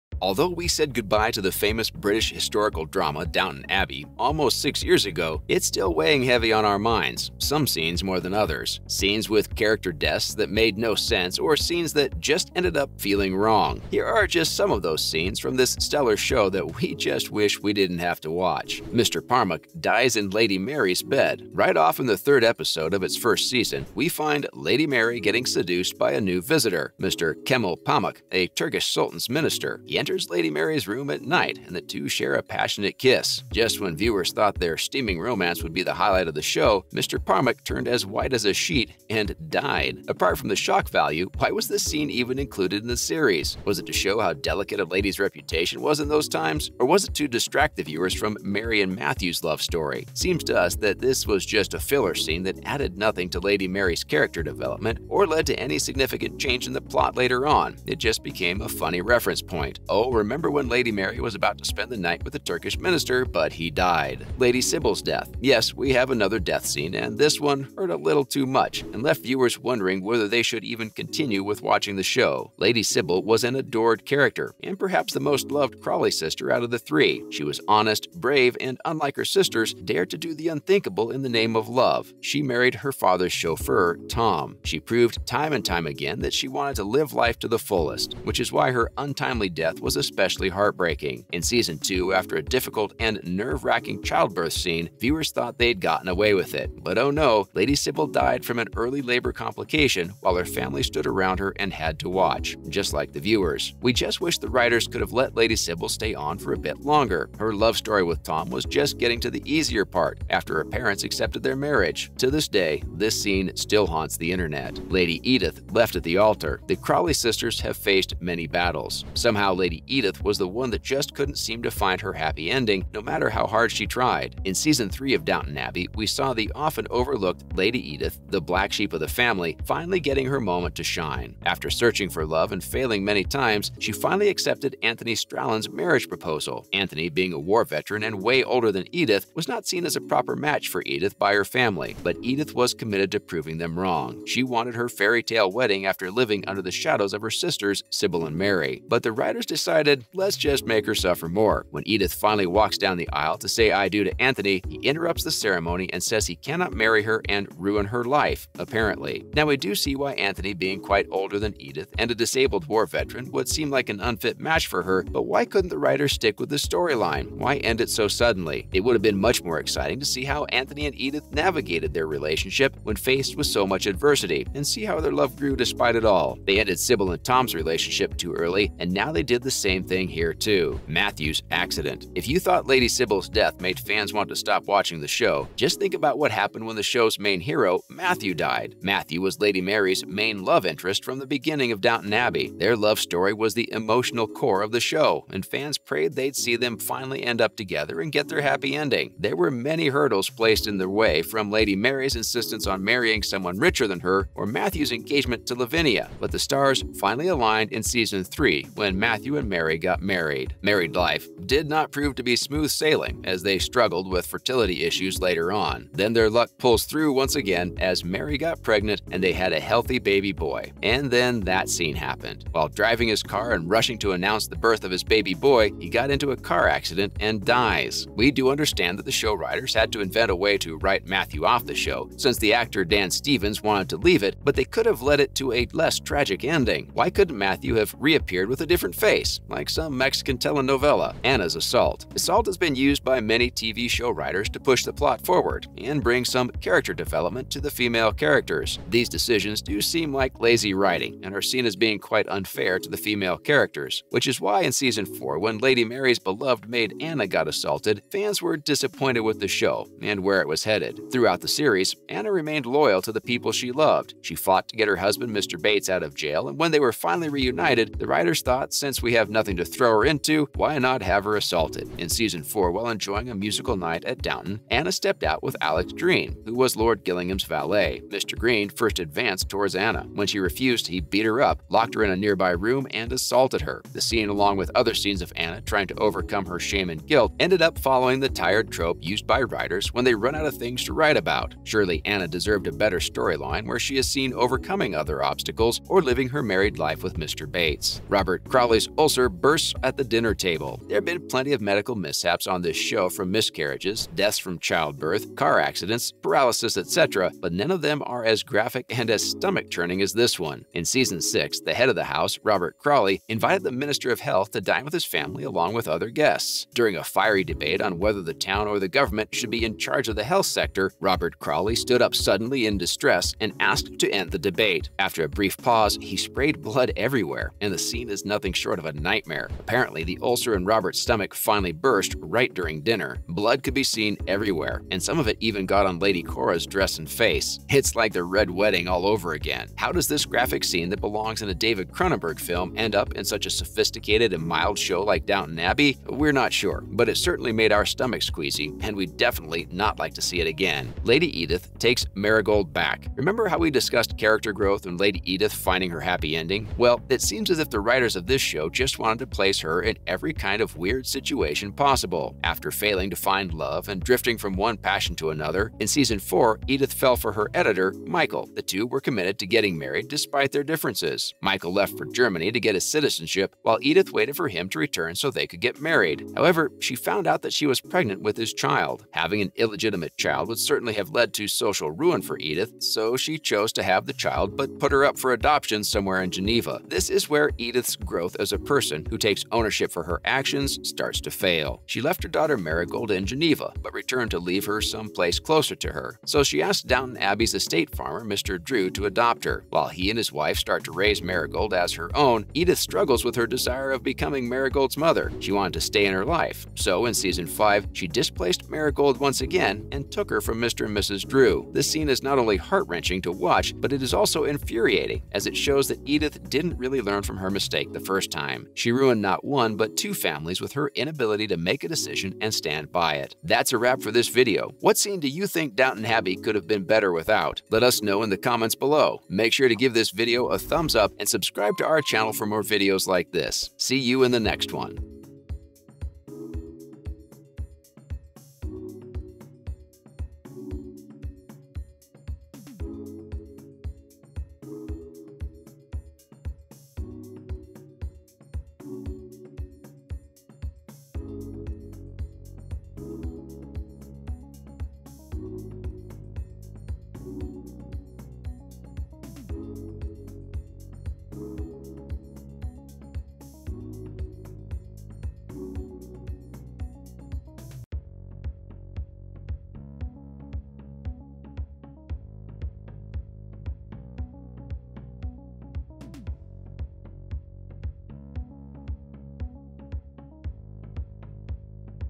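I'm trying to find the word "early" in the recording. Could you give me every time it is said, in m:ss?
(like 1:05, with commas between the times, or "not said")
1:38, 2:58.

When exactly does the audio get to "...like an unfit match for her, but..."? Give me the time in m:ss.
2:43.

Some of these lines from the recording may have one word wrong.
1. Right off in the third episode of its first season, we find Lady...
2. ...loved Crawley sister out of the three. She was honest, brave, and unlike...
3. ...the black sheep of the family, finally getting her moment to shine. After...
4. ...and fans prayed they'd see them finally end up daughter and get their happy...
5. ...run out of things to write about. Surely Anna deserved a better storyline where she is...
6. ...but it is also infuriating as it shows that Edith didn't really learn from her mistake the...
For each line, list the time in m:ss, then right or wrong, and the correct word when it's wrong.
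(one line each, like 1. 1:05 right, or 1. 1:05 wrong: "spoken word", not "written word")
1. 0:21 right
2. 1:15 right
3. 2:08 right
4. 3:15 wrong: "together", not "daughter"
5. 4:50 right
6. 6:53 right.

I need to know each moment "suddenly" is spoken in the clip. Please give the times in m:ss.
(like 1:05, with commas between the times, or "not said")
2:48, 5:22.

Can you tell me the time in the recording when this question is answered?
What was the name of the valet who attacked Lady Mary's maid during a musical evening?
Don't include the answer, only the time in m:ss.
4:35.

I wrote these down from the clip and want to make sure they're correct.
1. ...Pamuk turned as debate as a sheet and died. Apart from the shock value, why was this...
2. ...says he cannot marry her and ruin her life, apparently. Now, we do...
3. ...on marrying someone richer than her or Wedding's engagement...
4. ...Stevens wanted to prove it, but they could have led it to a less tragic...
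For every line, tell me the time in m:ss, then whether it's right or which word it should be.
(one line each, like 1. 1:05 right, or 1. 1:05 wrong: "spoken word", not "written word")
1. 0:37 wrong: "white", not "debate"
2. 2:36 right
3. 3:22 wrong: "Matthew", not "Wedding"
4. 3:53 wrong: "leave", not "prove".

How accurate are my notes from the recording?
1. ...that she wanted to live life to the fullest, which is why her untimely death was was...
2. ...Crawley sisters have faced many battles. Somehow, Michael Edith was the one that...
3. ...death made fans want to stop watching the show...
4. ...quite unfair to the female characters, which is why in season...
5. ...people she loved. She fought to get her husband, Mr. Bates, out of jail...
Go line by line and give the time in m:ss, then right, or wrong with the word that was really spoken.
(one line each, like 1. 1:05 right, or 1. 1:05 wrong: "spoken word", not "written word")
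1. 1:26 right
2. 1:56 wrong: "Lady", not "Michael"
3. 3:03 right
4. 4:11 right
5. 4:23 right.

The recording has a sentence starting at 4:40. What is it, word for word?
When she refused, he beat her up, locked her in a nearby room, and assaulted her.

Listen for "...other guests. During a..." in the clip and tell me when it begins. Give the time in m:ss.
5:15.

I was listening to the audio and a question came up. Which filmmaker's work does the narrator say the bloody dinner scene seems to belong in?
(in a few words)
David Cronenberg.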